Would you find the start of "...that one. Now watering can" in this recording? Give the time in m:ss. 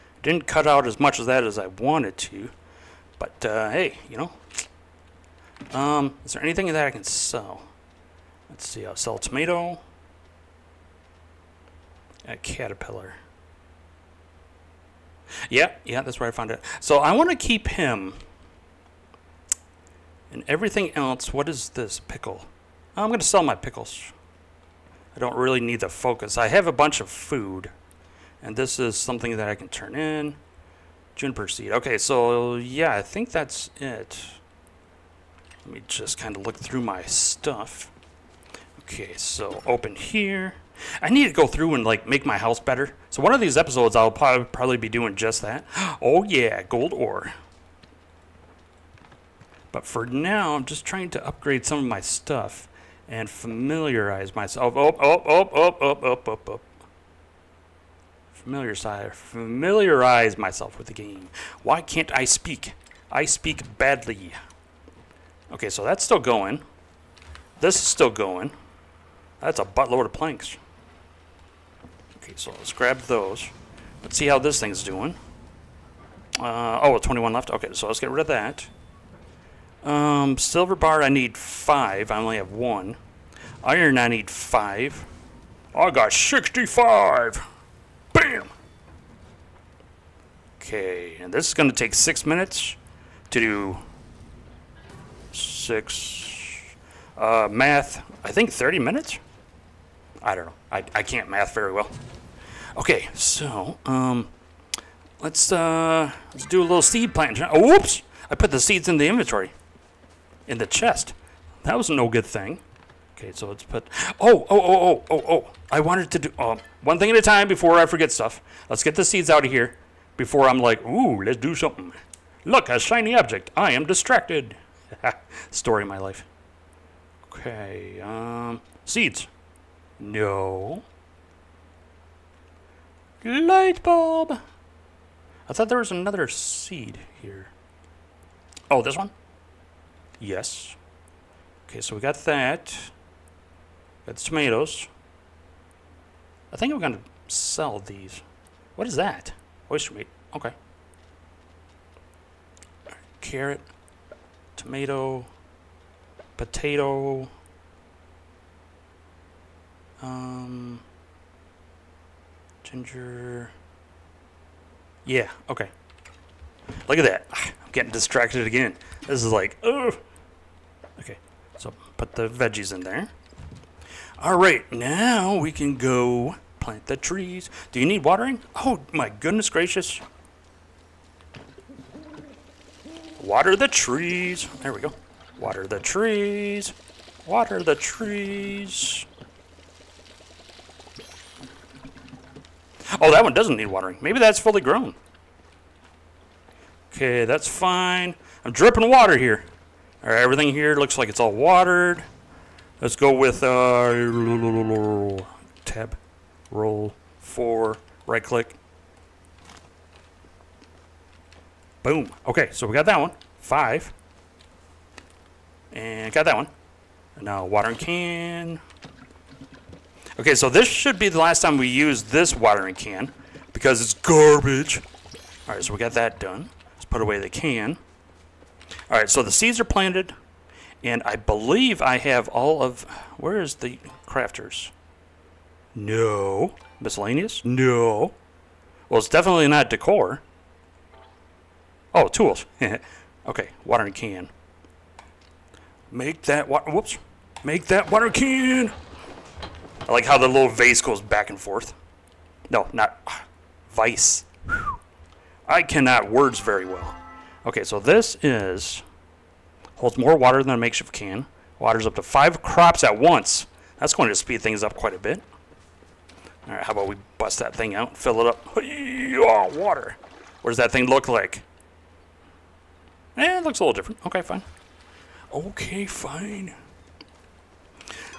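3:36.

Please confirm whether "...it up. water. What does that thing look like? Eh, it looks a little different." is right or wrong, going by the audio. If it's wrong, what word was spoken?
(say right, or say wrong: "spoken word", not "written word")
right.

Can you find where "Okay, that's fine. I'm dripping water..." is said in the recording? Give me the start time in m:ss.
3:16.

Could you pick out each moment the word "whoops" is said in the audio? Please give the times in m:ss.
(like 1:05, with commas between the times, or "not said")
1:47, 4:06.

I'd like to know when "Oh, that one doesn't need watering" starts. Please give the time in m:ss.
3:13.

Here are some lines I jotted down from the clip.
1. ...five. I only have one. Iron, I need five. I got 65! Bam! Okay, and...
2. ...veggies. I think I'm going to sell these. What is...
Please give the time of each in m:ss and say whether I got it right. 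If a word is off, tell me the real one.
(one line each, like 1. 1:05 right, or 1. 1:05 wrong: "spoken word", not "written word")
1. 1:21 right
2. 2:24 wrong: "tomatoes", not "veggies".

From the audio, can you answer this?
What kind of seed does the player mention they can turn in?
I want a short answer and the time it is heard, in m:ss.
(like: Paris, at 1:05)
Juniper seed, at 0:31.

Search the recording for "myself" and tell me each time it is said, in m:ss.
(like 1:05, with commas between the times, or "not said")
0:54, 1:00.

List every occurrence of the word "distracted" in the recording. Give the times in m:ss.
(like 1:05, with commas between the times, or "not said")
2:03, 2:47.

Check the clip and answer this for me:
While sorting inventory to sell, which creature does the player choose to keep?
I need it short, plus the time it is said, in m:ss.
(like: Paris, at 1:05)
Caterpillar, at 0:12.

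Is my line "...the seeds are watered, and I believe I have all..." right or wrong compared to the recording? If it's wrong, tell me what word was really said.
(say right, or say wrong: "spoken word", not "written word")
wrong: "planted", not "watered".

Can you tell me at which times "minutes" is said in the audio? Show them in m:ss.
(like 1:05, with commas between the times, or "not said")
1:32, 1:38.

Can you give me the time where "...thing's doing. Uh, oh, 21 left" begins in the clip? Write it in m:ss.
1:14.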